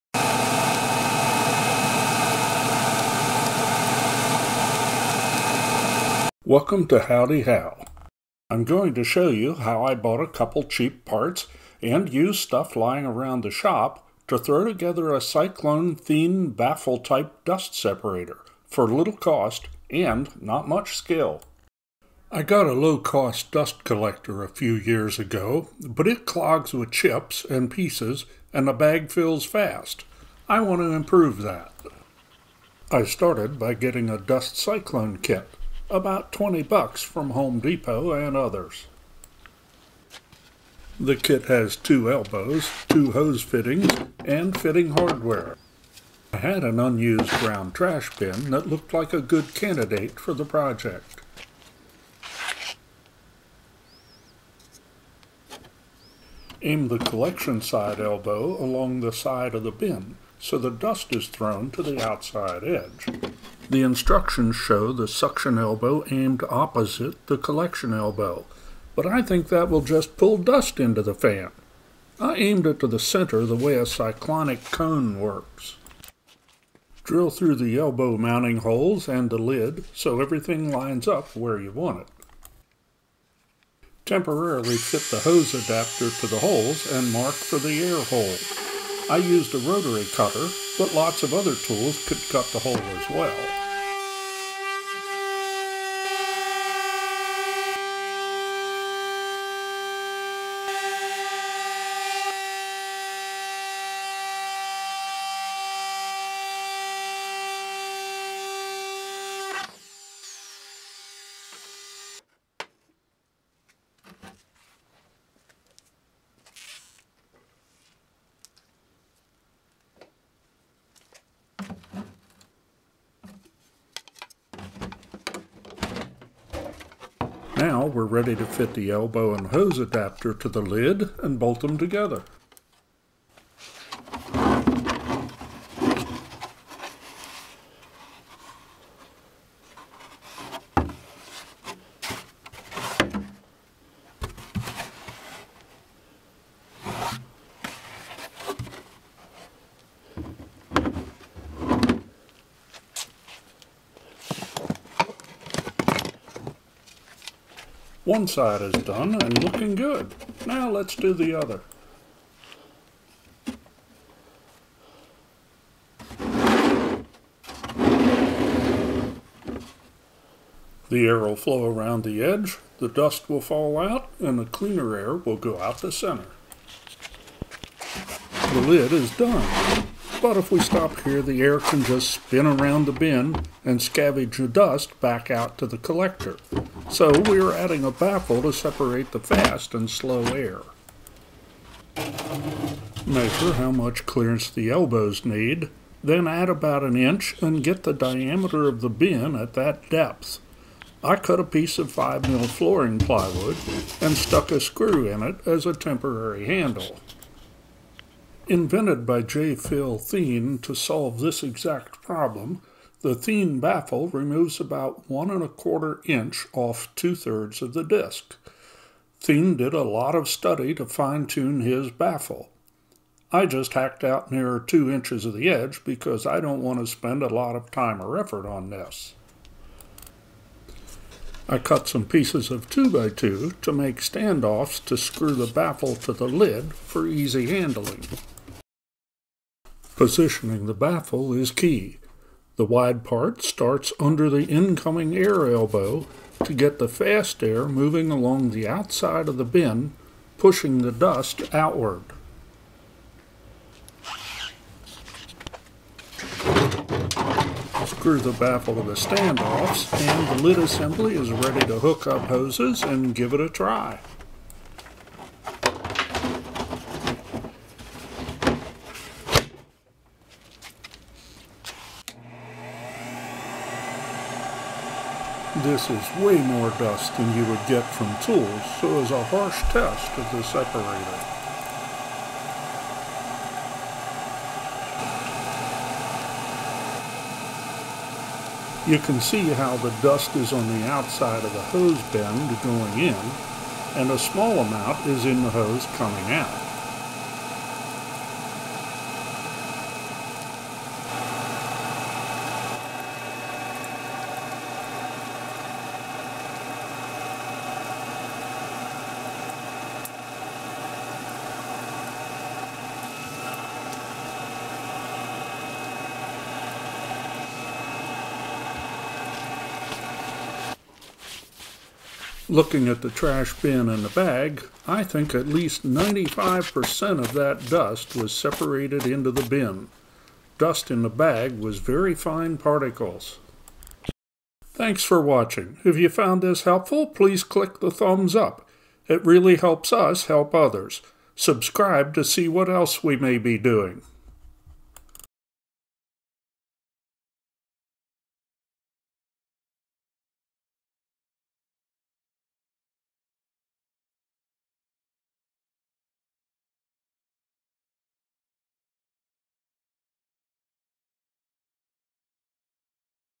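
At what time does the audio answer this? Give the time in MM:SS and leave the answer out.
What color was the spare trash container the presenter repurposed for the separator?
00:47.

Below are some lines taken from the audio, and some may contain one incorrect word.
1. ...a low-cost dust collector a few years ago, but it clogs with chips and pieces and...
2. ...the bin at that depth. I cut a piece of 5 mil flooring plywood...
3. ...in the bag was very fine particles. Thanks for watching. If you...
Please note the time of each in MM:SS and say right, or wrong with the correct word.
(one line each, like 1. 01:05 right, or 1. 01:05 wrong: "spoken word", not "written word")
1. 00:22 right
2. 03:18 right
3. 05:30 right.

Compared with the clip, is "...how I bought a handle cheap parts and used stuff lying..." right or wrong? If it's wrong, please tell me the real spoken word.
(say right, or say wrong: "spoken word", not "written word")
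wrong: "couple", not "handle".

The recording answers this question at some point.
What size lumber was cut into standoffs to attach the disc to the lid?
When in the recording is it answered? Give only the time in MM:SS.
03:52.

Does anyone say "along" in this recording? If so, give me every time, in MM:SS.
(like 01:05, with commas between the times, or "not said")
00:58, 04:08.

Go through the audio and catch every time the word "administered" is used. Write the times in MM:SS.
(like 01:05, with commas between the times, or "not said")
not said.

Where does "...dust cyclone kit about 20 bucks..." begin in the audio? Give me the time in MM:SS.
00:34.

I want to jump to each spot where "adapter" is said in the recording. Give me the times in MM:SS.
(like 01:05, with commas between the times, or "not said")
01:25, 02:09.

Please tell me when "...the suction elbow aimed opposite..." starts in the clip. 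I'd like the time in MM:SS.
01:04.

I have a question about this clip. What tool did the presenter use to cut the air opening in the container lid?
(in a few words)
rotary cutter.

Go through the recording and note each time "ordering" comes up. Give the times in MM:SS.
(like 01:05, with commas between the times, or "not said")
not said.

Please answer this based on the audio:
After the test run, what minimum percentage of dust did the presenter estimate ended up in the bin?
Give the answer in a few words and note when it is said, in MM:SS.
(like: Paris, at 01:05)
95%, at 05:25.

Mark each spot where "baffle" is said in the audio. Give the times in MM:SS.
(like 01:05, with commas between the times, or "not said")
00:16, 03:07, 03:33, 03:41, 03:55, 04:00, 04:18.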